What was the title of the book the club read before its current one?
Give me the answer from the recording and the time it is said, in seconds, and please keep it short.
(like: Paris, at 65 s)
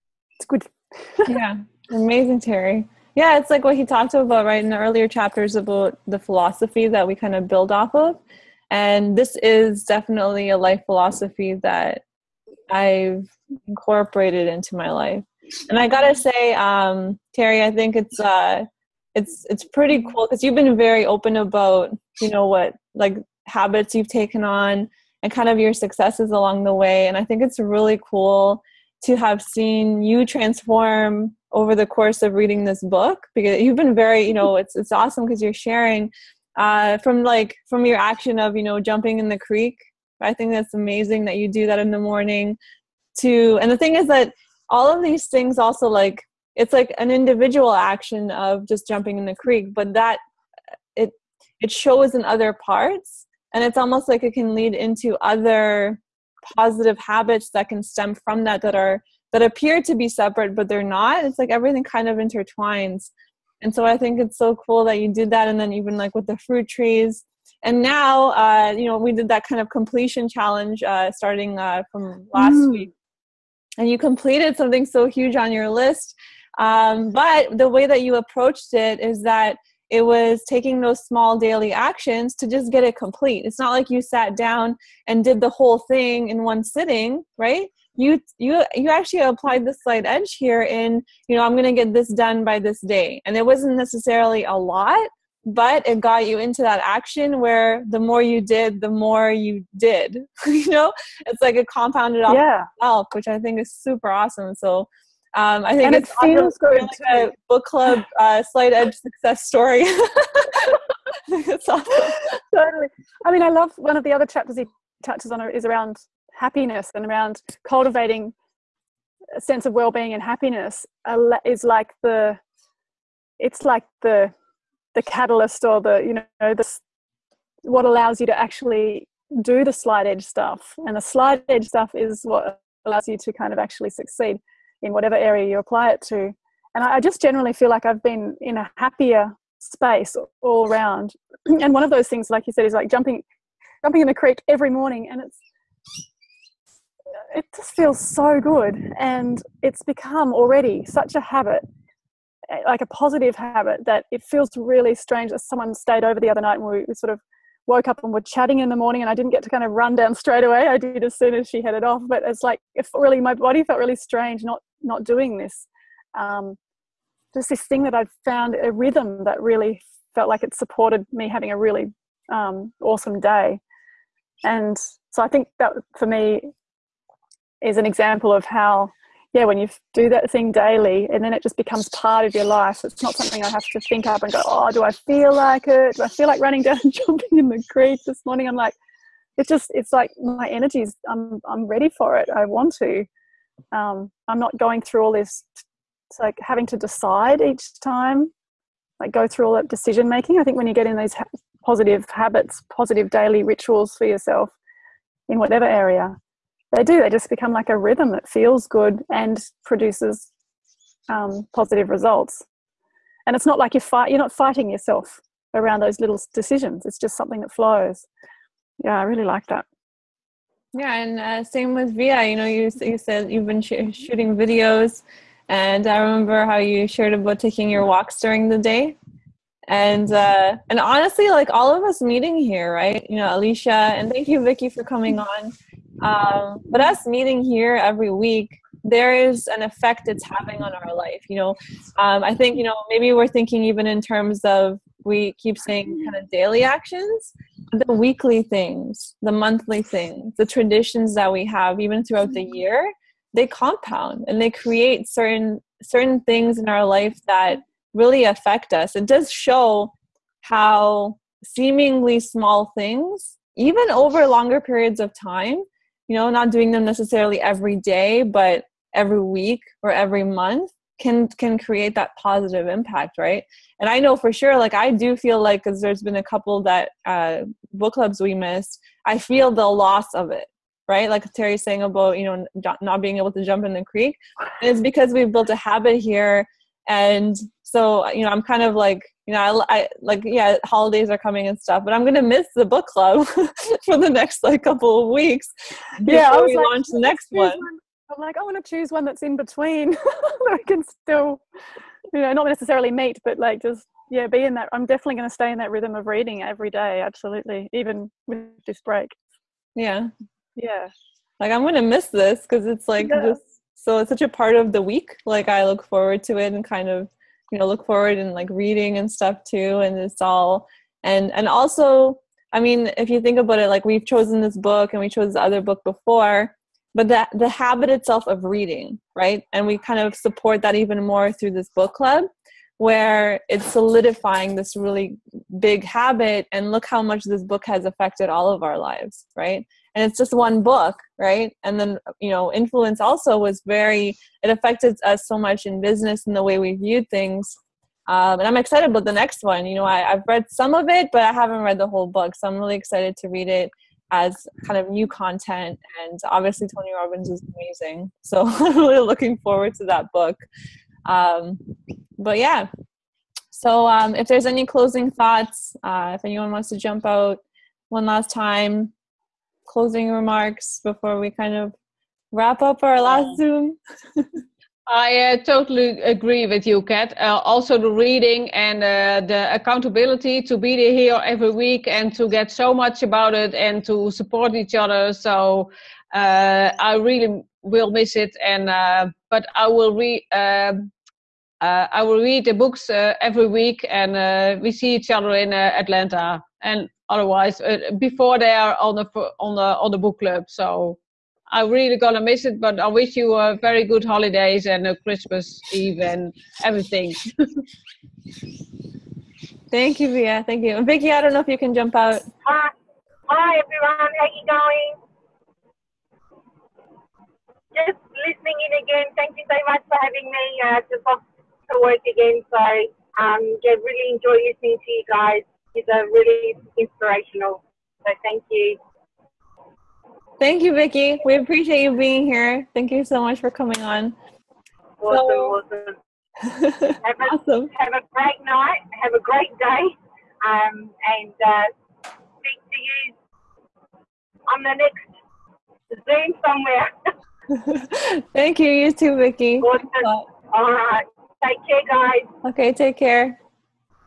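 Influence, at 342 s.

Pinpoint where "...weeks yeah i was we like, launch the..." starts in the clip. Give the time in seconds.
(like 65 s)
295 s.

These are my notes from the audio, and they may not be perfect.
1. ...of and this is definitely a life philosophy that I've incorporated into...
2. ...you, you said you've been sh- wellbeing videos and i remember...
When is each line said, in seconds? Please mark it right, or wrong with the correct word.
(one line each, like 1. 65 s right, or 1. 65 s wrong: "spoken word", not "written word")
1. 7 s right
2. 222 s wrong: "shooting", not "wellbeing".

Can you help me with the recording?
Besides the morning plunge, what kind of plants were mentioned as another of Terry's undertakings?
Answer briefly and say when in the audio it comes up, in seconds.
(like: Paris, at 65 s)
fruit trees, at 66 s.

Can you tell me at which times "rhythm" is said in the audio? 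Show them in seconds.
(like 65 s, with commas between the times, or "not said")
168 s, 207 s, 305 s.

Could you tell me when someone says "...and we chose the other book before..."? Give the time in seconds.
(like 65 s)
324 s.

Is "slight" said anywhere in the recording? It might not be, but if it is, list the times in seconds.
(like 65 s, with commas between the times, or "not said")
89 s, 108 s.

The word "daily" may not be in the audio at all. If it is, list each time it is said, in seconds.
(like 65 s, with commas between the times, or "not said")
81 s, 180 s, 203 s, 246 s.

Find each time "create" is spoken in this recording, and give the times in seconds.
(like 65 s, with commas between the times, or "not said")
254 s, 271 s.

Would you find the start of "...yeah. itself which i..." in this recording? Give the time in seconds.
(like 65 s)
102 s.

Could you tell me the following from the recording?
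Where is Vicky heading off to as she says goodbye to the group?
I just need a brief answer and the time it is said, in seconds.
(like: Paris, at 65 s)
work, at 421 s.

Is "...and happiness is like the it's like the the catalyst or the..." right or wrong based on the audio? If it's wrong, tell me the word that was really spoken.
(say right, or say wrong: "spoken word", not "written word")
right.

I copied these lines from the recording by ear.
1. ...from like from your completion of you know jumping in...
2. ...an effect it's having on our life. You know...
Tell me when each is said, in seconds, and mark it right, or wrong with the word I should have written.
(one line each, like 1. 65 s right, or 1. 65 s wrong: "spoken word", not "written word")
1. 36 s wrong: "action", not "completion"
2. 239 s right.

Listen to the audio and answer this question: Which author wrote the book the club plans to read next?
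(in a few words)
Tony Robbins.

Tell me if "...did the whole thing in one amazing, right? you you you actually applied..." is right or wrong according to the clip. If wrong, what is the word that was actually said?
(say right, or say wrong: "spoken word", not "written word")
wrong: "sitting", not "amazing".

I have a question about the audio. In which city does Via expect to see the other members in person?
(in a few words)
Atlanta.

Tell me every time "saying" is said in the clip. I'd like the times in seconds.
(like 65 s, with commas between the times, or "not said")
245 s, 281 s.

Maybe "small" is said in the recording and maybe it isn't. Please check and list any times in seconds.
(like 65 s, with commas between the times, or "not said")
81 s, 262 s.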